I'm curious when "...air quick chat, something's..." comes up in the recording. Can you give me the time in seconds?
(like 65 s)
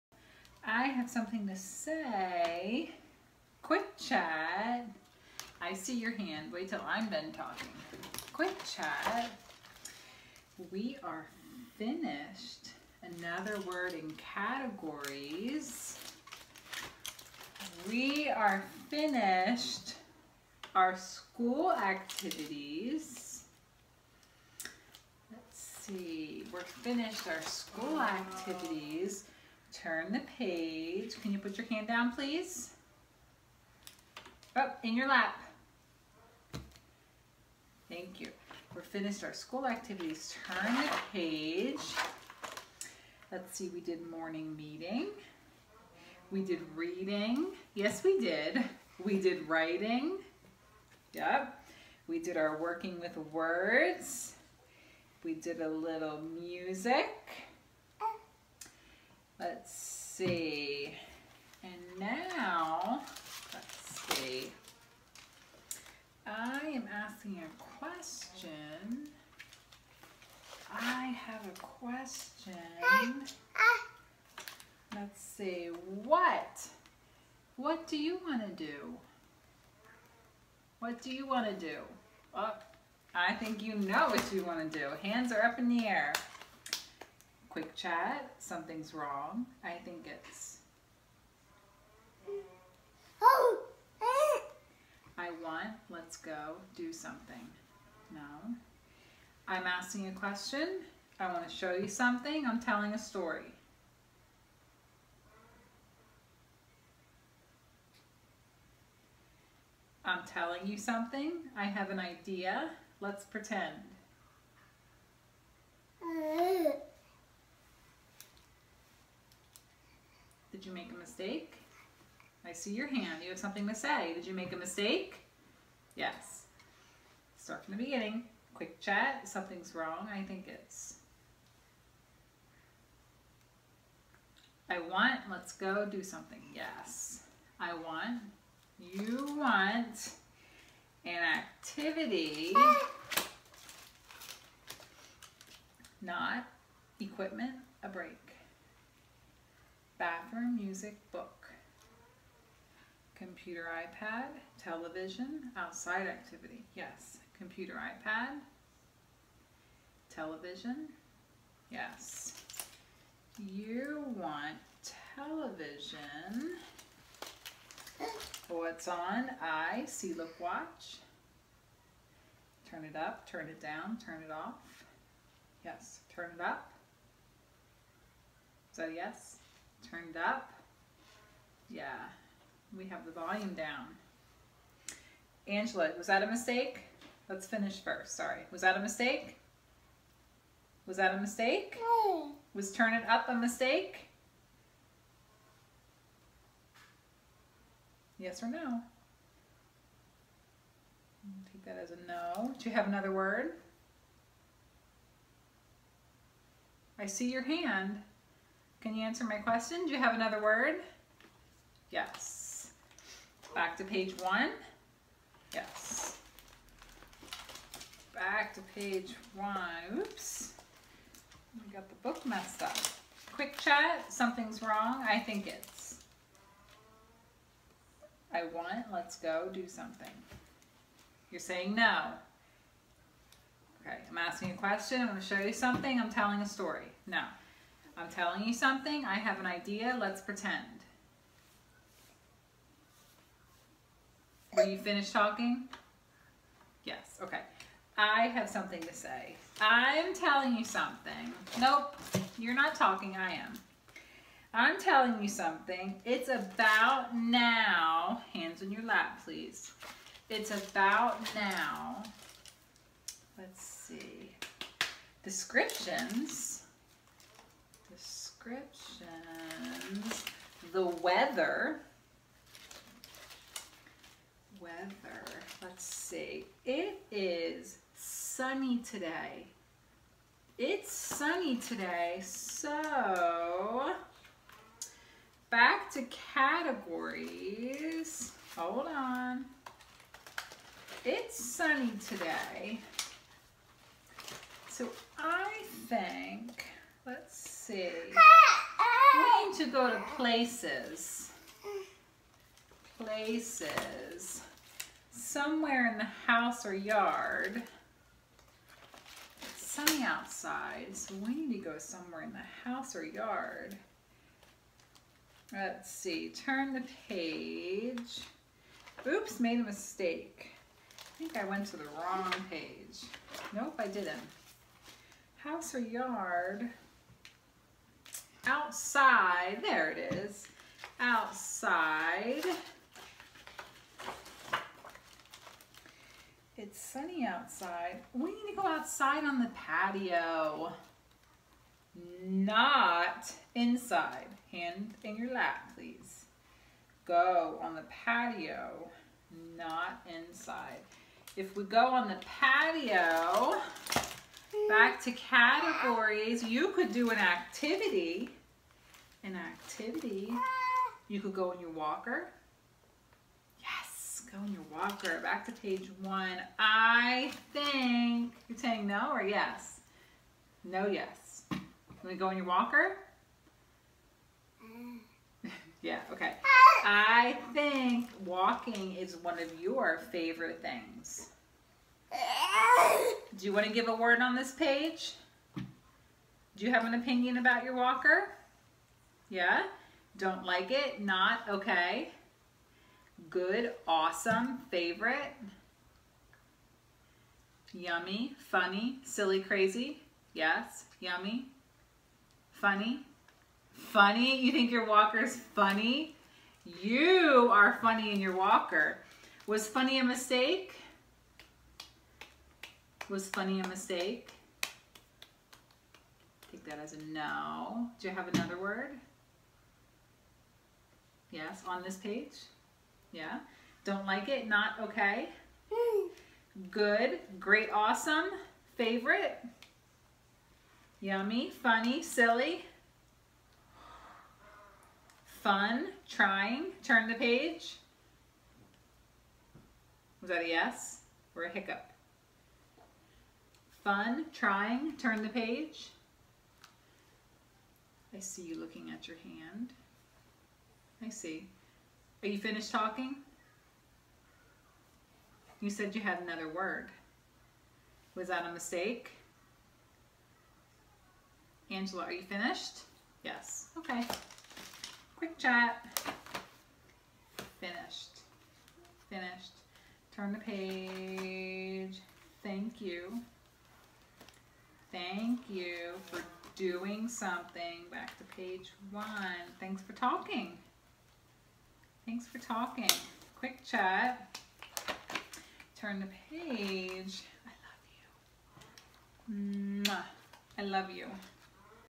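85 s.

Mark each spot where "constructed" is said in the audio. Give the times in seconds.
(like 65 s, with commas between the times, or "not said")
not said.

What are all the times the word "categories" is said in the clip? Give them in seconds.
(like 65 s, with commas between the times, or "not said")
14 s, 286 s, 355 s.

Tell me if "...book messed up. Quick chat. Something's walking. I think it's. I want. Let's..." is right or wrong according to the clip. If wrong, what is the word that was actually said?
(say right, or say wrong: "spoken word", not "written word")
wrong: "wrong", not "walking".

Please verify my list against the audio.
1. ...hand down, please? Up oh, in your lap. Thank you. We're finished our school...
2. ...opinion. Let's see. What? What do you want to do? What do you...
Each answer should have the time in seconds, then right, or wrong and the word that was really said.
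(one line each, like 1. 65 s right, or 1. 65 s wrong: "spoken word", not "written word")
1. 31 s right
2. 71 s wrong: "question", not "opinion".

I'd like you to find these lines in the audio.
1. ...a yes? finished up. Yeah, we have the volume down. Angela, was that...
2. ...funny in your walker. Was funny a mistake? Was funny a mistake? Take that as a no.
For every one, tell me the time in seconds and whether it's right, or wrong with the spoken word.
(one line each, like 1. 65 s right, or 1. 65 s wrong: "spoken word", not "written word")
1. 178 s wrong: "turned", not "finished"
2. 407 s right.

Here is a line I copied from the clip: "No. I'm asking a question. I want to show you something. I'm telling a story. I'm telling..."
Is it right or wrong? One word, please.
right.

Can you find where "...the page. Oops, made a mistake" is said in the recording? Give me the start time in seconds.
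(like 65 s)
316 s.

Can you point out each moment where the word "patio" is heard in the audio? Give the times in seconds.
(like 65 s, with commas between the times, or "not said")
339 s, 347 s, 352 s.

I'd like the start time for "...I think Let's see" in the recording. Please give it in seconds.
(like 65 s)
295 s.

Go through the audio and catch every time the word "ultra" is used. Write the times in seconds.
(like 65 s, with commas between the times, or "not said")
not said.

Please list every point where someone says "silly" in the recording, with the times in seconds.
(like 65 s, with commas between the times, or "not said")
399 s, 432 s.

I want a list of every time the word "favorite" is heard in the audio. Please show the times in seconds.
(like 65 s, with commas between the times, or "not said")
380 s, 394 s, 428 s.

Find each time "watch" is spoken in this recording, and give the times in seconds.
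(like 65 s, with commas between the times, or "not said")
170 s.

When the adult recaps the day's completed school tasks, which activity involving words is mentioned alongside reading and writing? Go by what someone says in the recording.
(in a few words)
working with words.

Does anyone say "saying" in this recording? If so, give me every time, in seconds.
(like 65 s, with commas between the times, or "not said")
231 s, 368 s.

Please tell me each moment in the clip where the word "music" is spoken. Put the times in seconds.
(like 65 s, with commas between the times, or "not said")
56 s, 150 s.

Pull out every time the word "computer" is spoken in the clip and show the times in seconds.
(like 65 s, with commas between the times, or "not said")
153 s, 157 s.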